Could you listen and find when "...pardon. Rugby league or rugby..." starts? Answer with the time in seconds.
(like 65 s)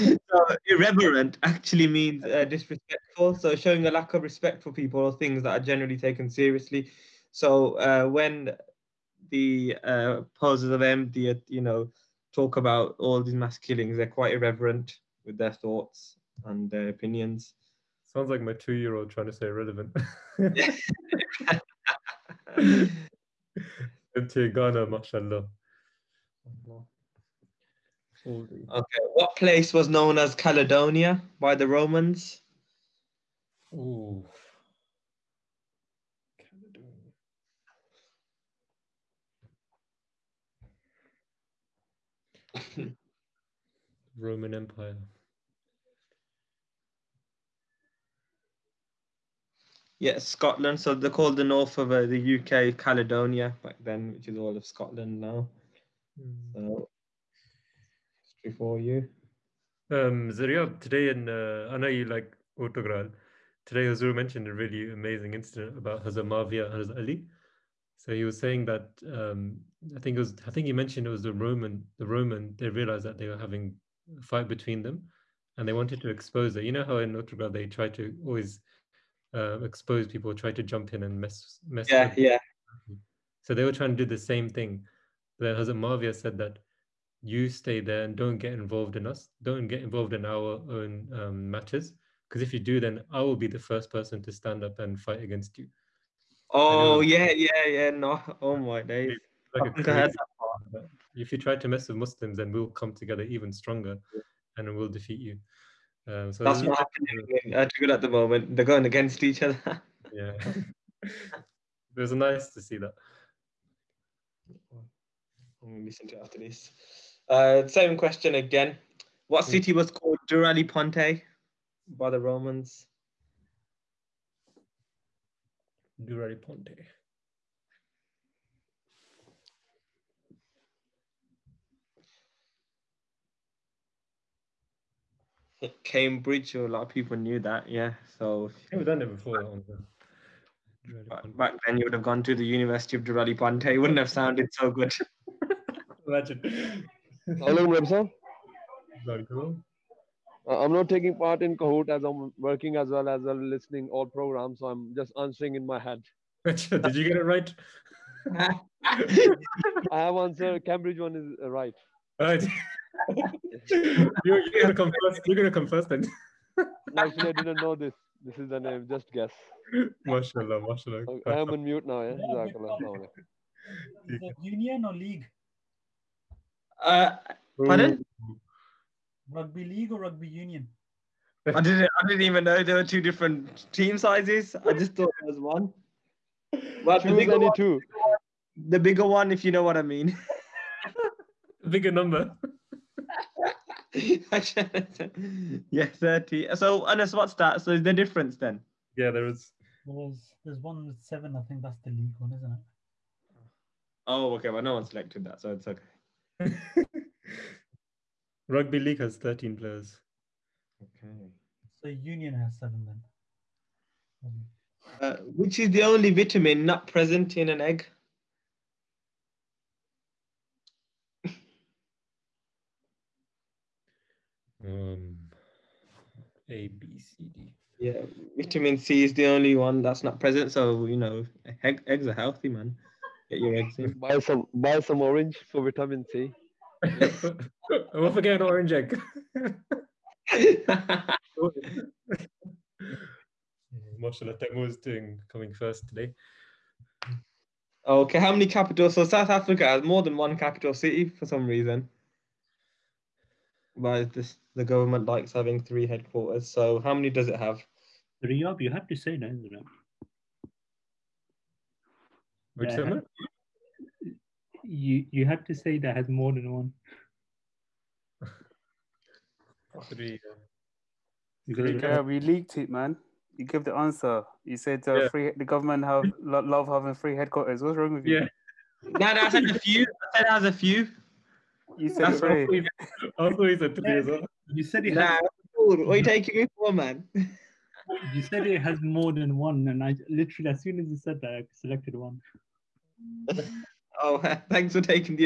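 177 s.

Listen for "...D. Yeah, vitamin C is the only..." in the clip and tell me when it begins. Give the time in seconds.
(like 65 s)
227 s.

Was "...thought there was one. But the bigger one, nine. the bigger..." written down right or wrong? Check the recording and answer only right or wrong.
wrong.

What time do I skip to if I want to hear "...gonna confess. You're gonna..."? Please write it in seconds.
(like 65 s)
164 s.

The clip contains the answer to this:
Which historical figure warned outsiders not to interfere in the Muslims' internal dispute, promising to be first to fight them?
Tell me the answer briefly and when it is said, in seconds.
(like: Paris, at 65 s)
Hazrat Muawiya, at 85 s.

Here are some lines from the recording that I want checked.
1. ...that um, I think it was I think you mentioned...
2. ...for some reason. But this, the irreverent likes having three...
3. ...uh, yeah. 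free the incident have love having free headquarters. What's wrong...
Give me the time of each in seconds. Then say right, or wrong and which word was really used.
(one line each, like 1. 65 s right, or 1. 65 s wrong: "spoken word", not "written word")
1. 68 s right
2. 251 s wrong: "government", not "irreverent"
3. 274 s wrong: "government", not "incident".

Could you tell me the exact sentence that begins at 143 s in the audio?
It wouldn't have sounded so good.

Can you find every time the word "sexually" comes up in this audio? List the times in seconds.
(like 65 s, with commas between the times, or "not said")
not said.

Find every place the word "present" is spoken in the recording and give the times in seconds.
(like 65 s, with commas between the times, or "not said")
216 s, 230 s.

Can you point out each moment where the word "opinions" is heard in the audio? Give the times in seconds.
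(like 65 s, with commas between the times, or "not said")
16 s.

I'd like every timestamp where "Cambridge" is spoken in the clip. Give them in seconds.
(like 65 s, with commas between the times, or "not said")
135 s, 160 s.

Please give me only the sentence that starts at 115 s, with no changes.
I'm gonna listen to after this.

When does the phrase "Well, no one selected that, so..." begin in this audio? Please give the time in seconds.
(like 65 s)
204 s.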